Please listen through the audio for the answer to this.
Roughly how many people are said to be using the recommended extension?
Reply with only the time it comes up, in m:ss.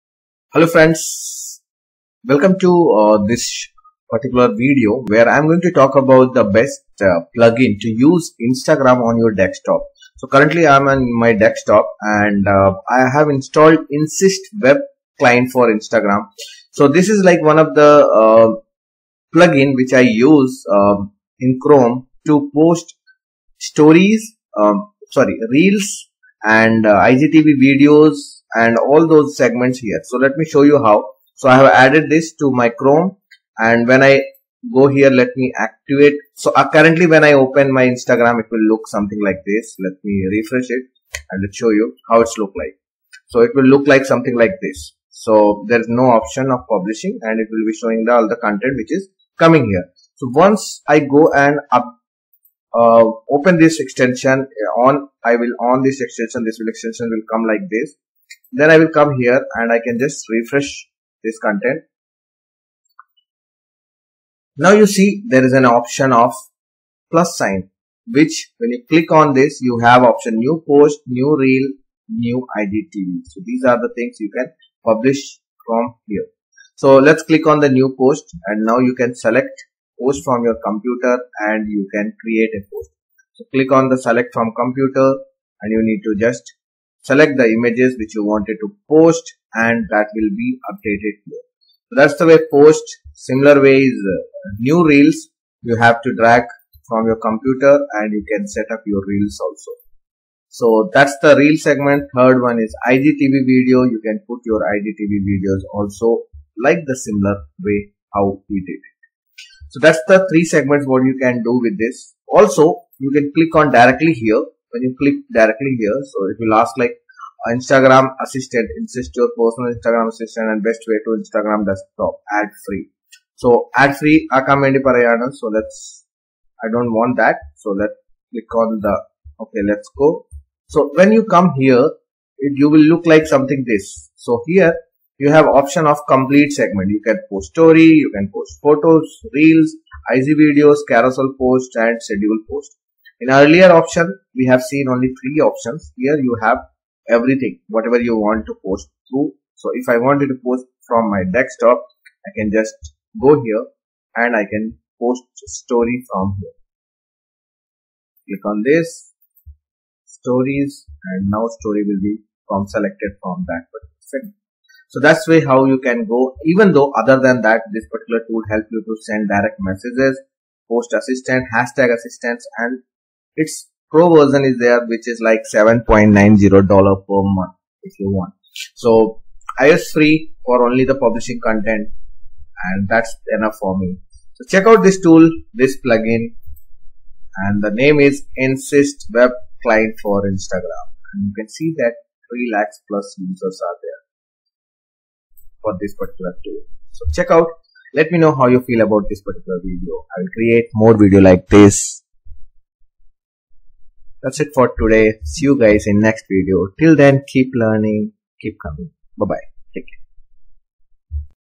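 3:12.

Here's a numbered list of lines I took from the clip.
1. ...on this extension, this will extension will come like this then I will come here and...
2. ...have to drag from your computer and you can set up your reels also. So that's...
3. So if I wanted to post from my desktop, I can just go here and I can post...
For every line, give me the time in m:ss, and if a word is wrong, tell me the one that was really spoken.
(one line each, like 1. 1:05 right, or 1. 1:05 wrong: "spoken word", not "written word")
1. 0:55 right
2. 1:35 right
3. 2:29 right.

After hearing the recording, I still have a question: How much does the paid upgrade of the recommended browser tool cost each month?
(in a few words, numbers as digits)
$7.90.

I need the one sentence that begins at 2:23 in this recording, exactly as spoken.
In earlier option, we have seen only three options.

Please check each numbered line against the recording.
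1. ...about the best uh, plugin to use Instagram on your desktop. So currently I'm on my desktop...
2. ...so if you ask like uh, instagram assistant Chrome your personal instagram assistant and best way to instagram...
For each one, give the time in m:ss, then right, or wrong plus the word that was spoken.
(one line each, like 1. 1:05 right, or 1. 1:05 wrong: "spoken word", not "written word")
1. 0:05 right
2. 1:56 wrong: "Inssist", not "Chrome".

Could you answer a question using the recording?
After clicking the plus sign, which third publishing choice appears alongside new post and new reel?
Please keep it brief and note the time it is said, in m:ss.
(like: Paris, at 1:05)
New IGTV, at 1:12.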